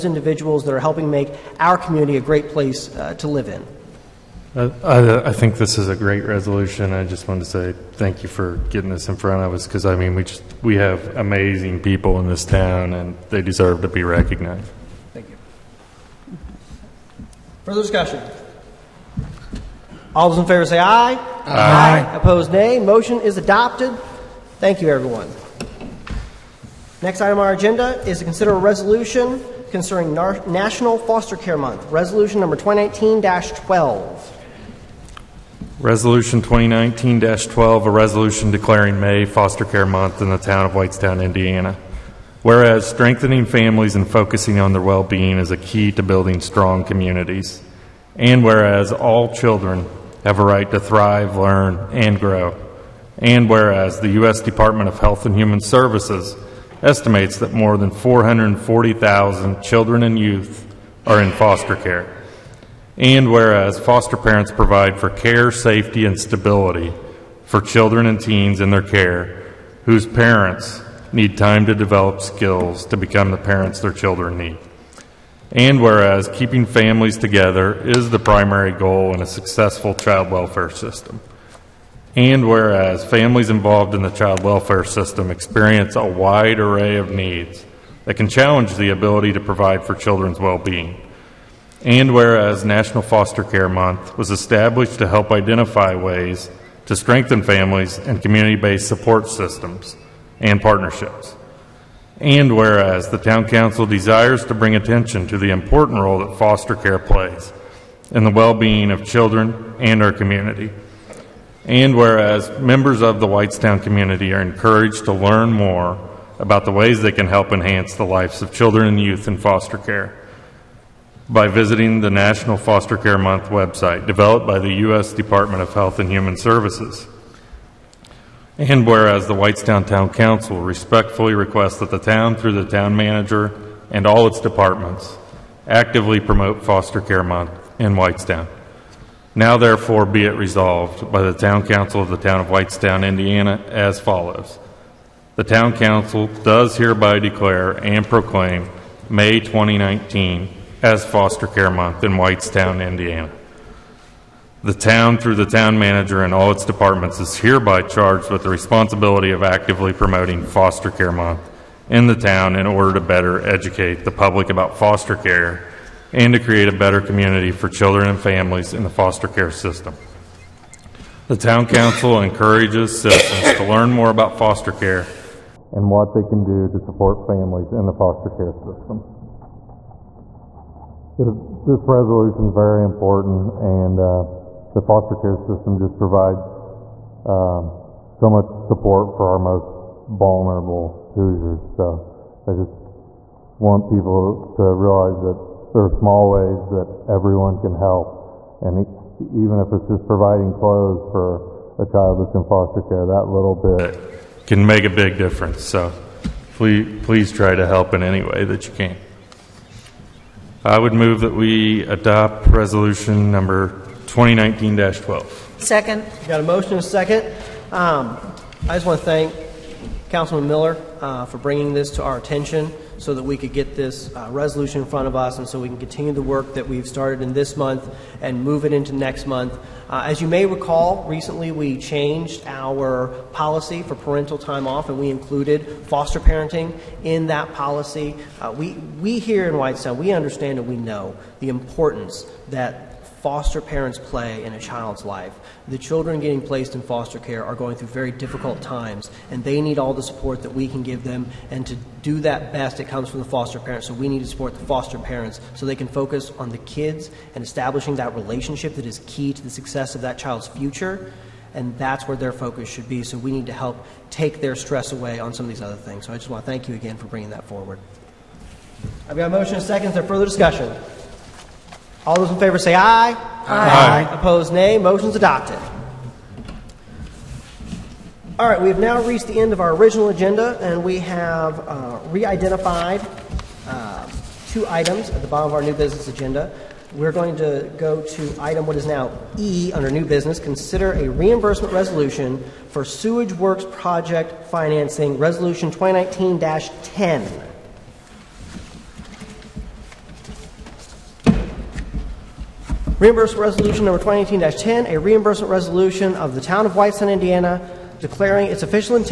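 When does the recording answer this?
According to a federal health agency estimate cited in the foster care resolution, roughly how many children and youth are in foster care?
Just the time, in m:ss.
0:57.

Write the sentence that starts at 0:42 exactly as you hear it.
Whereas strengthening families and focusing on their well being is a key to building strong communities.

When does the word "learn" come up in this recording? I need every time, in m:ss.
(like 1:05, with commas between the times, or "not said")
0:51, 1:55, 2:53.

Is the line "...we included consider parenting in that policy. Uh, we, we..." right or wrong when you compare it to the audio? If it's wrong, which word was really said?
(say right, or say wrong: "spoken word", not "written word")
wrong: "foster", not "consider".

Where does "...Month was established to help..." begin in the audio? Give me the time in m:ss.
1:33.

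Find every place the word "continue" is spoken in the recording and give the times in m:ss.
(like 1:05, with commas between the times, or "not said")
3:45.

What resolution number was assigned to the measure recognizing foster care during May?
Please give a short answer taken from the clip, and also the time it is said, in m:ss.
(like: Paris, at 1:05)
2019-12, at 3:32.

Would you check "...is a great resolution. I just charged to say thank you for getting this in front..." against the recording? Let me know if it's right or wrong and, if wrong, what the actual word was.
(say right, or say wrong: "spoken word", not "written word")
wrong: "wanted", not "charged".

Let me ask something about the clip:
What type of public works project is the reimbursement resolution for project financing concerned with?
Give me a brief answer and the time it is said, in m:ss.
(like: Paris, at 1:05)
Sewage works, at 4:52.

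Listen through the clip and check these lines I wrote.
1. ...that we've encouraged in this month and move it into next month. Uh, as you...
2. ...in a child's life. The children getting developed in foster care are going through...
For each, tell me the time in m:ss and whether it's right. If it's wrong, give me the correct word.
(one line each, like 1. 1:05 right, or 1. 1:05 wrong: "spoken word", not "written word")
1. 3:46 wrong: "started", not "encouraged"
2. 4:04 wrong: "placed", not "developed".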